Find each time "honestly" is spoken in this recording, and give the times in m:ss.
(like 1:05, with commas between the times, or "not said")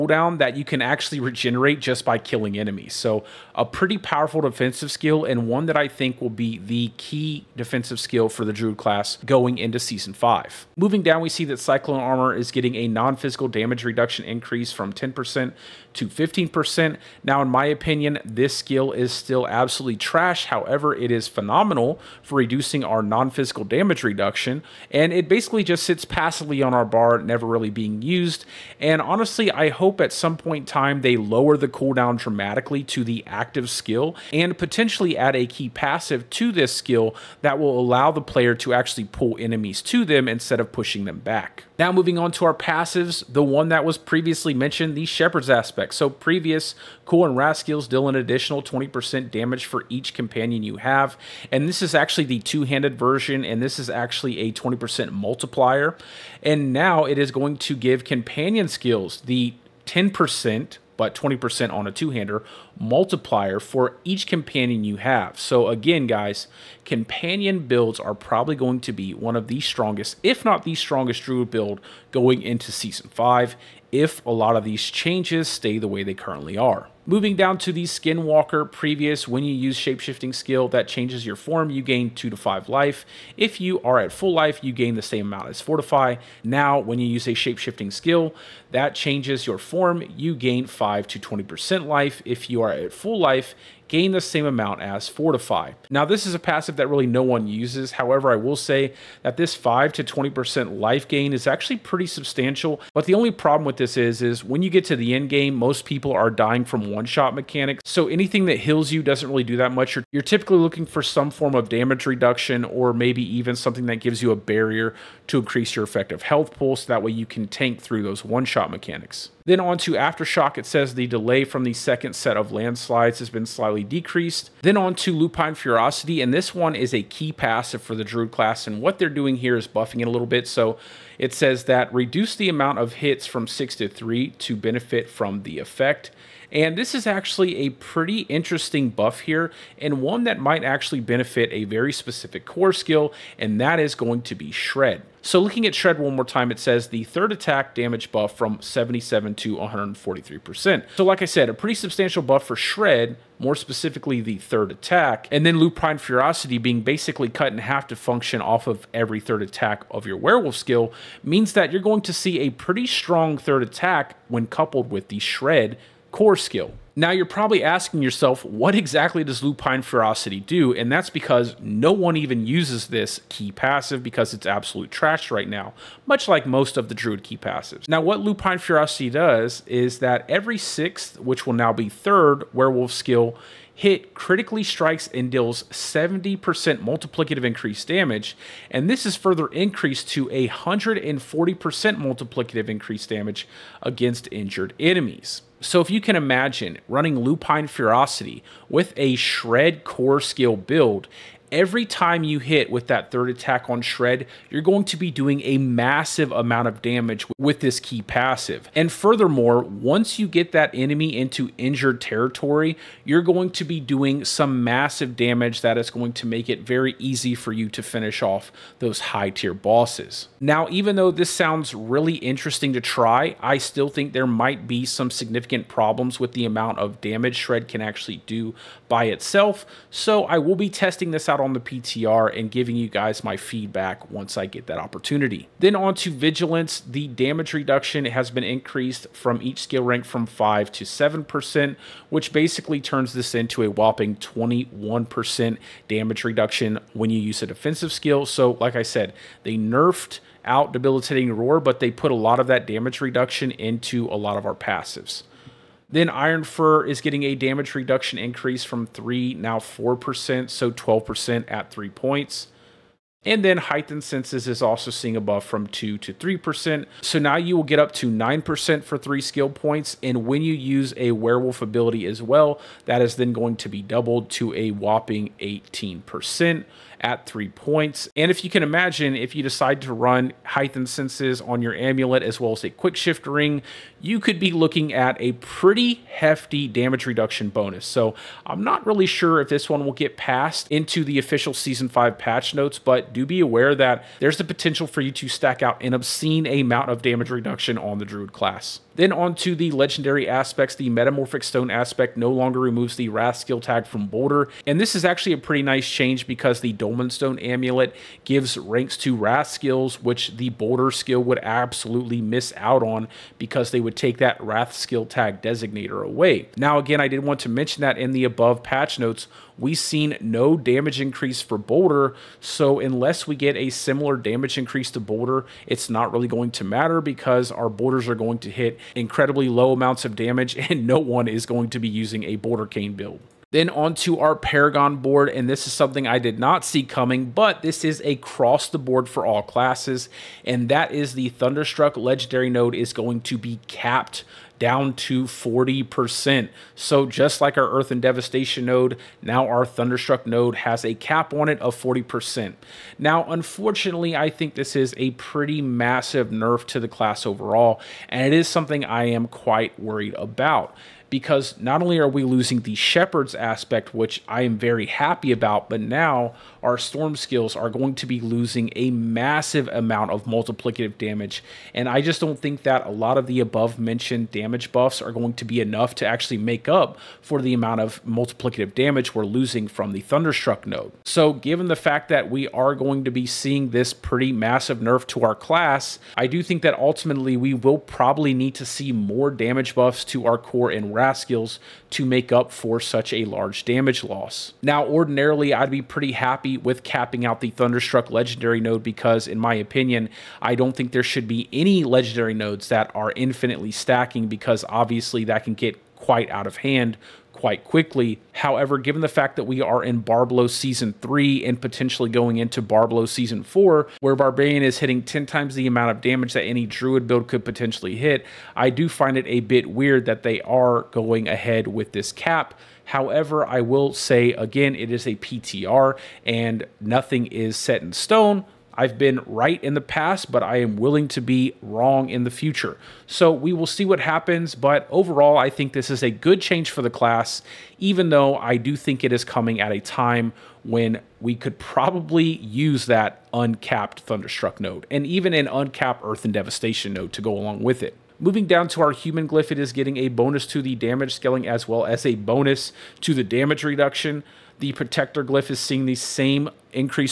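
0:29.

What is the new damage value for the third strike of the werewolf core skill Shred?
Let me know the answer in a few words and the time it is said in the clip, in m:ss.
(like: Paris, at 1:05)
143%, at 2:29.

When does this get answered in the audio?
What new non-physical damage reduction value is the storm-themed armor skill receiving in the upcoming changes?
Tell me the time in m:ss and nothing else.
0:16.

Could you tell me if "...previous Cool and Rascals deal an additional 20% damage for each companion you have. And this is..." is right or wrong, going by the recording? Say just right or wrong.
right.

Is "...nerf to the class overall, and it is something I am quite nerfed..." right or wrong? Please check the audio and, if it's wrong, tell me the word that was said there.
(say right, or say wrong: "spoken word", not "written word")
wrong: "worried", not "nerfed".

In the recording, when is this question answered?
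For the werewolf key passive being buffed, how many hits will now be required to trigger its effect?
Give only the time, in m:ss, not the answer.
2:13.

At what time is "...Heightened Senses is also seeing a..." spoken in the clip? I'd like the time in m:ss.
4:23.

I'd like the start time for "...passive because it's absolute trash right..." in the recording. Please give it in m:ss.
2:53.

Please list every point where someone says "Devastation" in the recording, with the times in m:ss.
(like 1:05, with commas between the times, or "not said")
5:48, 7:26.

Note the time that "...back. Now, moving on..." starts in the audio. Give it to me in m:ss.
0:41.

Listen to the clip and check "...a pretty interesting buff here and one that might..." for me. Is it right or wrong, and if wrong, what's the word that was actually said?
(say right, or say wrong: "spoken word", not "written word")
right.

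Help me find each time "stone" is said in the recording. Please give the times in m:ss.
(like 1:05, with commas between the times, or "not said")
5:01, 5:07, 7:07.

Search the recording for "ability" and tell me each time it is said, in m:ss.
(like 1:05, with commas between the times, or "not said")
4:31.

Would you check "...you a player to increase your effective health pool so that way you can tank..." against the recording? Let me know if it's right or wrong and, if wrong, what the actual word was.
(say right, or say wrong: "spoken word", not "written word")
wrong: "barrier", not "player".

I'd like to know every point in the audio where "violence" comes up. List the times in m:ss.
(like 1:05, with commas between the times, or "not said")
not said.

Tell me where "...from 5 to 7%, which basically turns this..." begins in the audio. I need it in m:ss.
4:00.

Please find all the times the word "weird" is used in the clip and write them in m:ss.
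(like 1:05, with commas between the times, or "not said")
6:59.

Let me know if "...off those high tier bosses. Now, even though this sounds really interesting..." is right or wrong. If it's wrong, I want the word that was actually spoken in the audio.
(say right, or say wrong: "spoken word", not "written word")
right.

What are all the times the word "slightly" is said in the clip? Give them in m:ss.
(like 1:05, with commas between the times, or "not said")
2:03.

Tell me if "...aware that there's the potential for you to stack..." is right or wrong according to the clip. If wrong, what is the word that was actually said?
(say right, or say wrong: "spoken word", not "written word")
right.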